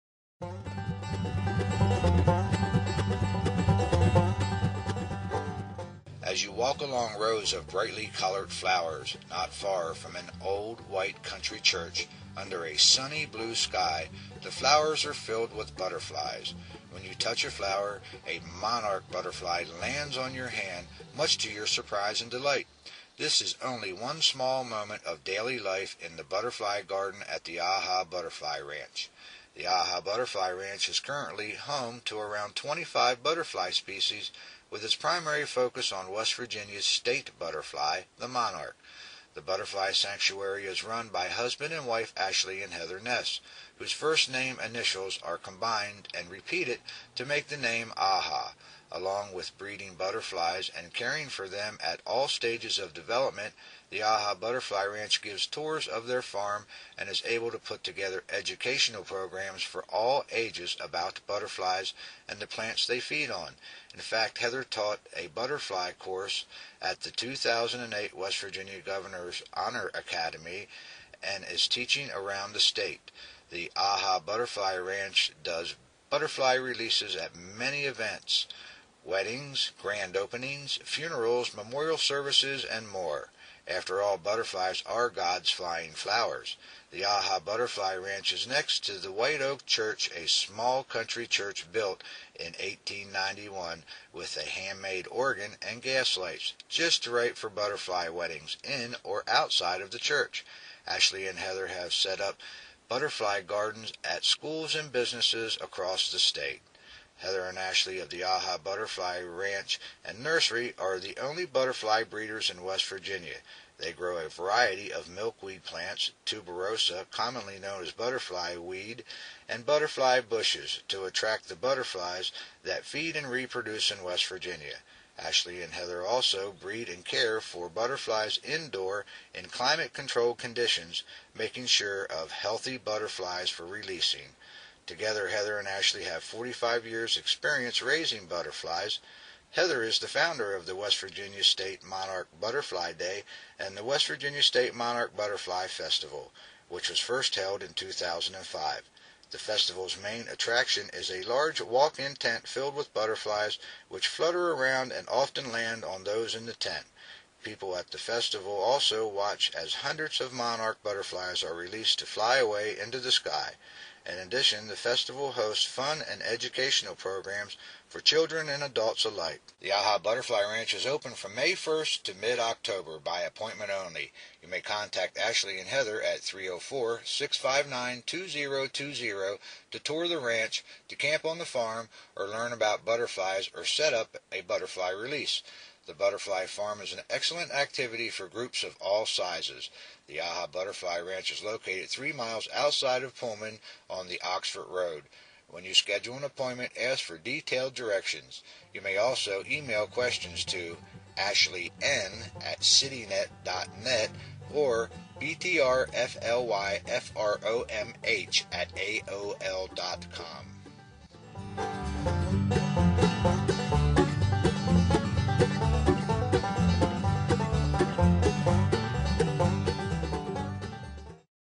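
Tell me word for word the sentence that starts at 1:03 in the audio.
In fact, Heather taught a butterfly course at the 2008 West Virginia Governor's Honor Academy and is teaching around the state.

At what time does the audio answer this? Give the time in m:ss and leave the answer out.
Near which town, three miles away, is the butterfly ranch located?
3:13.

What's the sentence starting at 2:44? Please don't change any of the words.
In addition, the festival hosts fun and educational programs for children and adults alike.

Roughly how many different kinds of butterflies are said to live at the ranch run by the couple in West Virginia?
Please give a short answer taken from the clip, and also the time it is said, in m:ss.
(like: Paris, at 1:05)
25, at 0:32.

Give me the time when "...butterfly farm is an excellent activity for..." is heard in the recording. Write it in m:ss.
3:05.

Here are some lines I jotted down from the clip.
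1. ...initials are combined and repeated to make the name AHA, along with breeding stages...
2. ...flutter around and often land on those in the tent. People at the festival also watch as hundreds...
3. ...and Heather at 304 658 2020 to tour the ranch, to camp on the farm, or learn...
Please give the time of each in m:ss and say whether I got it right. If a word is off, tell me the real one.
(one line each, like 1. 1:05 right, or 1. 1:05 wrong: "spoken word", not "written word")
1. 0:44 wrong: "butterflies", not "stages"
2. 2:34 right
3. 2:55 wrong: "659", not "658".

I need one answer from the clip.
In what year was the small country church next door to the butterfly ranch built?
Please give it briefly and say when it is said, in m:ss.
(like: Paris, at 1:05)
1891, at 1:32.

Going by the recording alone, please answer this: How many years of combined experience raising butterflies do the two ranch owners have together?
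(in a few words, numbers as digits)
45.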